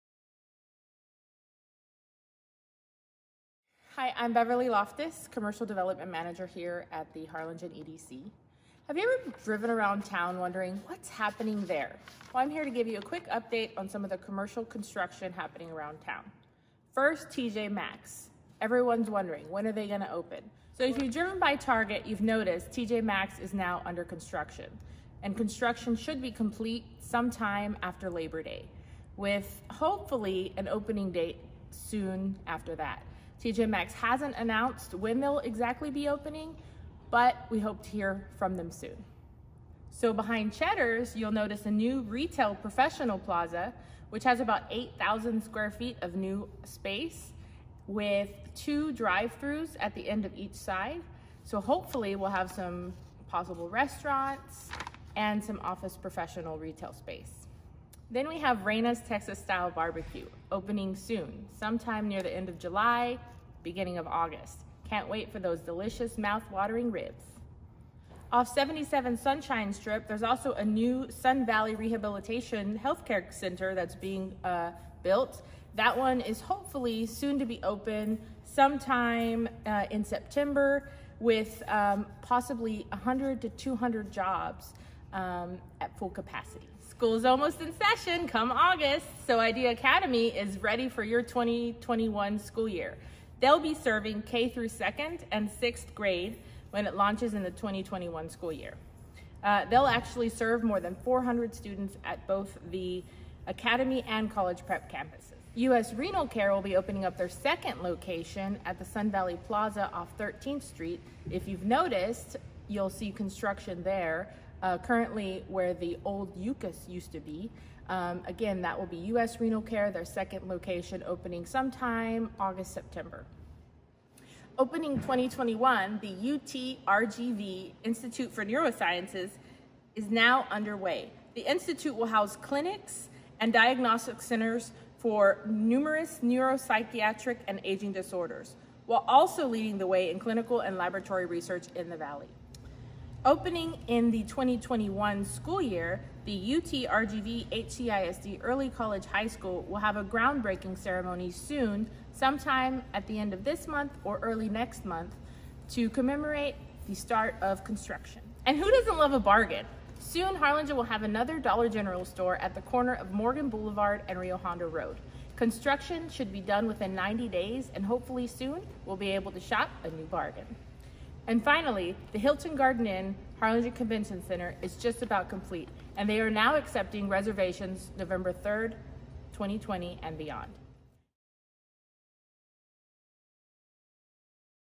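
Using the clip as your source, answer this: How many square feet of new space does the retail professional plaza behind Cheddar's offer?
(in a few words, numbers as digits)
8,000.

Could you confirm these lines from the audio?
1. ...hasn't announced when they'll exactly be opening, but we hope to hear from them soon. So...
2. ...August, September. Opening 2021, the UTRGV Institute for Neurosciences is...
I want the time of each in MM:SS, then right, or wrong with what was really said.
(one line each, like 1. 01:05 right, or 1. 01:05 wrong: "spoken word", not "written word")
1. 00:33 right
2. 02:02 right.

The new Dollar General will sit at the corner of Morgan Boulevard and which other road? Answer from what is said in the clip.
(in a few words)
Rio Hondo Road.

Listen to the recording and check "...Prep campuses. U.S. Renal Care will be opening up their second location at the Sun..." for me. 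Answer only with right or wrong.
right.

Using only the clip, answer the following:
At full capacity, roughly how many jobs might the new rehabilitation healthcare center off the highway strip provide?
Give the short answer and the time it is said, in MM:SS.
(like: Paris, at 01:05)
100 to 200, at 01:22.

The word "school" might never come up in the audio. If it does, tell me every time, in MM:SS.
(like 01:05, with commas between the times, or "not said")
01:26, 01:32, 01:38, 02:25, 02:29.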